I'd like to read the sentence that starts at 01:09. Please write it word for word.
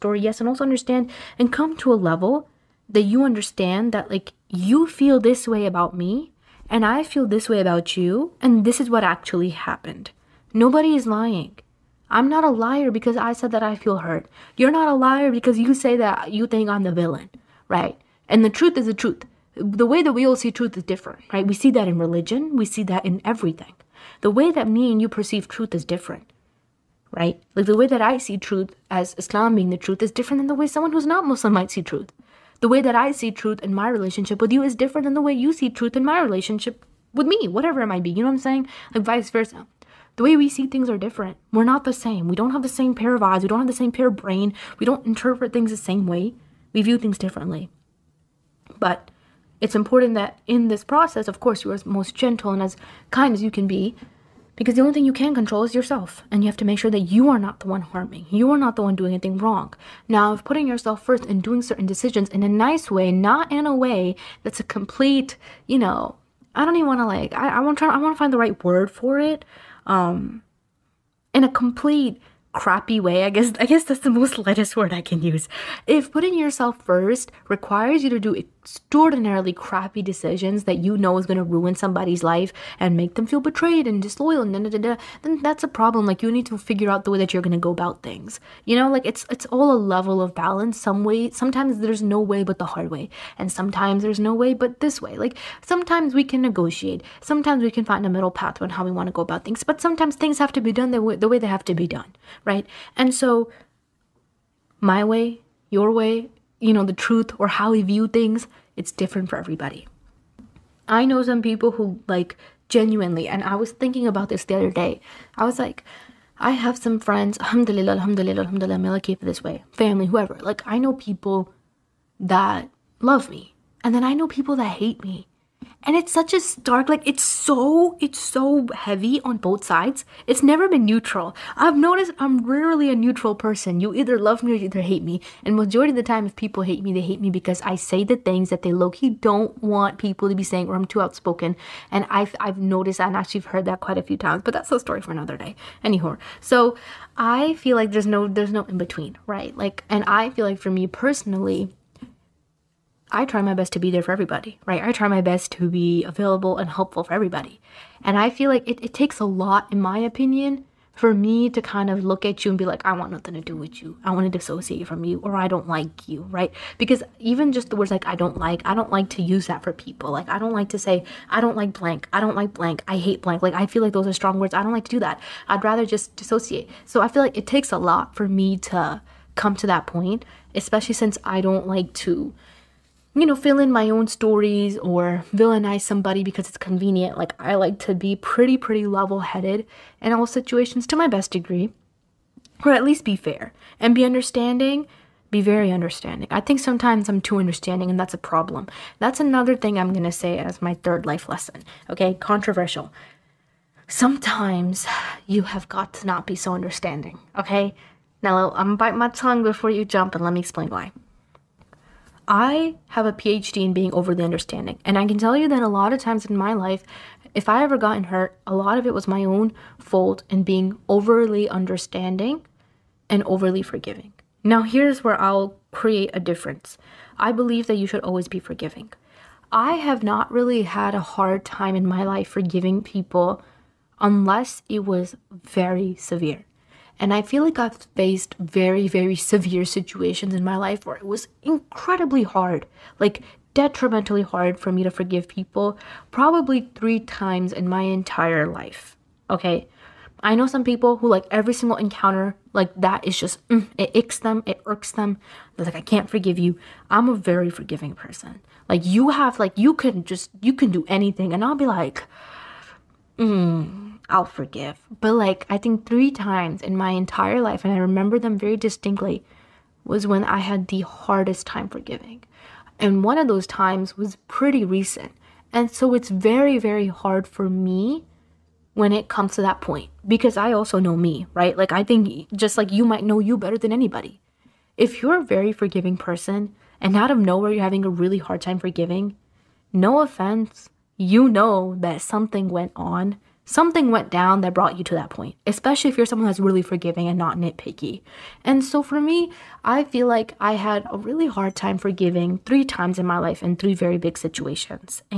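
Um, in a complete, crappy way.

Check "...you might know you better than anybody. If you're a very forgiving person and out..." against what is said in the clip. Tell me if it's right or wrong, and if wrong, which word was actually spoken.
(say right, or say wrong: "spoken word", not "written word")
right.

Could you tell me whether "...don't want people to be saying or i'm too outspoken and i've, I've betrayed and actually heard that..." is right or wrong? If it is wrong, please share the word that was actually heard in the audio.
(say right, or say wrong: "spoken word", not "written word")
wrong: "noticed", not "betrayed".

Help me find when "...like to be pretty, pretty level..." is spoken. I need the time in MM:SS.
03:07.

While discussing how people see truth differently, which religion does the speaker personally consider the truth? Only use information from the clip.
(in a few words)
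Islam.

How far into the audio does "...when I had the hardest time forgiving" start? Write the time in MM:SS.
04:30.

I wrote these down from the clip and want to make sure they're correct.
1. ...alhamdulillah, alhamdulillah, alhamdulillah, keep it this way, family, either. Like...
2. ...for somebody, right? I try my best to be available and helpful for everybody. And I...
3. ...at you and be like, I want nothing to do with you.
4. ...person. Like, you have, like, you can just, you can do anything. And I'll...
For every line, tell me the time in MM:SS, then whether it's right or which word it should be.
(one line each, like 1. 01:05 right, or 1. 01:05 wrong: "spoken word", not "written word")
1. 01:57 wrong: "whoever", not "either"
2. 02:34 wrong: "everybody", not "somebody"
3. 02:42 right
4. 04:17 right.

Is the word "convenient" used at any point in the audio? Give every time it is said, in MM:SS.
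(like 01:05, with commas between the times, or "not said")
03:06.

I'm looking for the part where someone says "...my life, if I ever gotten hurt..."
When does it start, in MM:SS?
03:36.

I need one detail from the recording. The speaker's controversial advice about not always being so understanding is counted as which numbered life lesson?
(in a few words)
third.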